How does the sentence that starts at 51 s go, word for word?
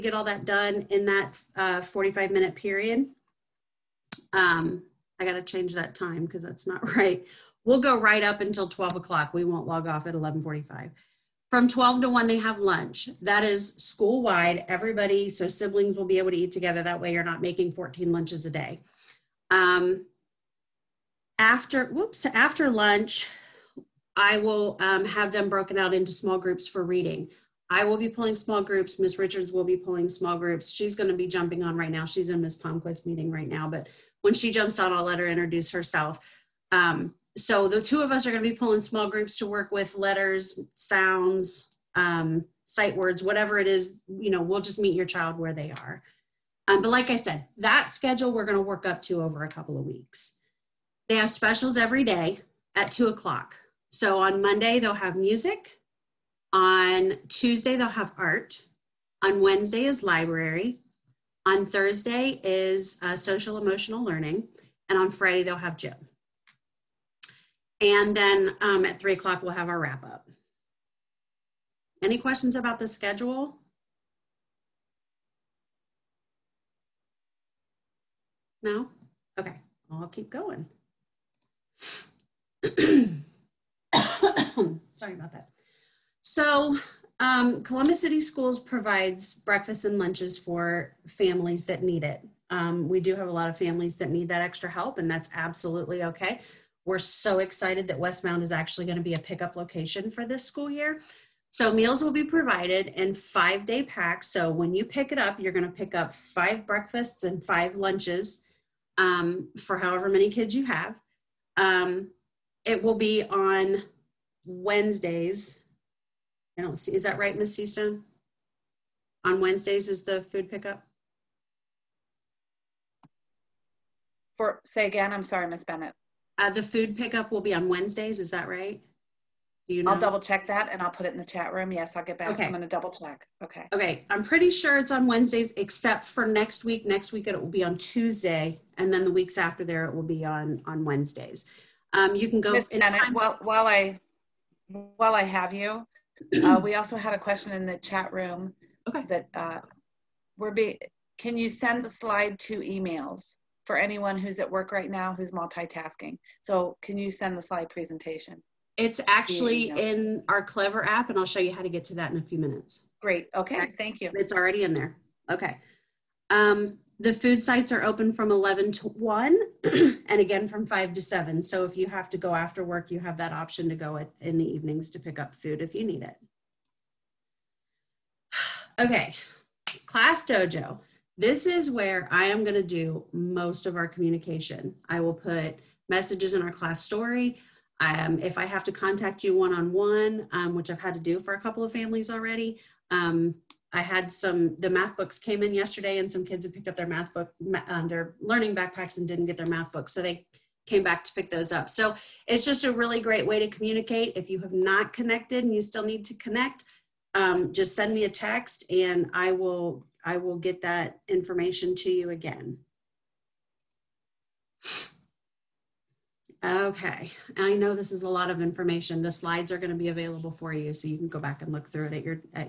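They have specials every day at two o'clock.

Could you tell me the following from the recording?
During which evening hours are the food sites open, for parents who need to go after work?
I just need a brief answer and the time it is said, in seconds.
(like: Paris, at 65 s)
5 to 7, at 170 s.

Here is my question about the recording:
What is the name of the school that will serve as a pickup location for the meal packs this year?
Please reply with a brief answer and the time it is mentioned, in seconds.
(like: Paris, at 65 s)
West Mound, at 97 s.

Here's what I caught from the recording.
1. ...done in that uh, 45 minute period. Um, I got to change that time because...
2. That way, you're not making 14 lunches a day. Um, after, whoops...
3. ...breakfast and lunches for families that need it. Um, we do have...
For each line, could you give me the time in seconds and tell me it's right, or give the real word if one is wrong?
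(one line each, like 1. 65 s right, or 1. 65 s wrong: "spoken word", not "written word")
1. 0 s right
2. 16 s right
3. 89 s right.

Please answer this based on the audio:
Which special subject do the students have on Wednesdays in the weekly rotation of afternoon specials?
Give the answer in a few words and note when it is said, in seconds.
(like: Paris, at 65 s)
library, at 60 s.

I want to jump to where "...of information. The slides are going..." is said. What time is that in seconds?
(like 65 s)
218 s.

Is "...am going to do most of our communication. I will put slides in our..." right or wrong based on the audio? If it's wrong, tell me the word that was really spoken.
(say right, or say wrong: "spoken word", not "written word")
wrong: "messages", not "slides".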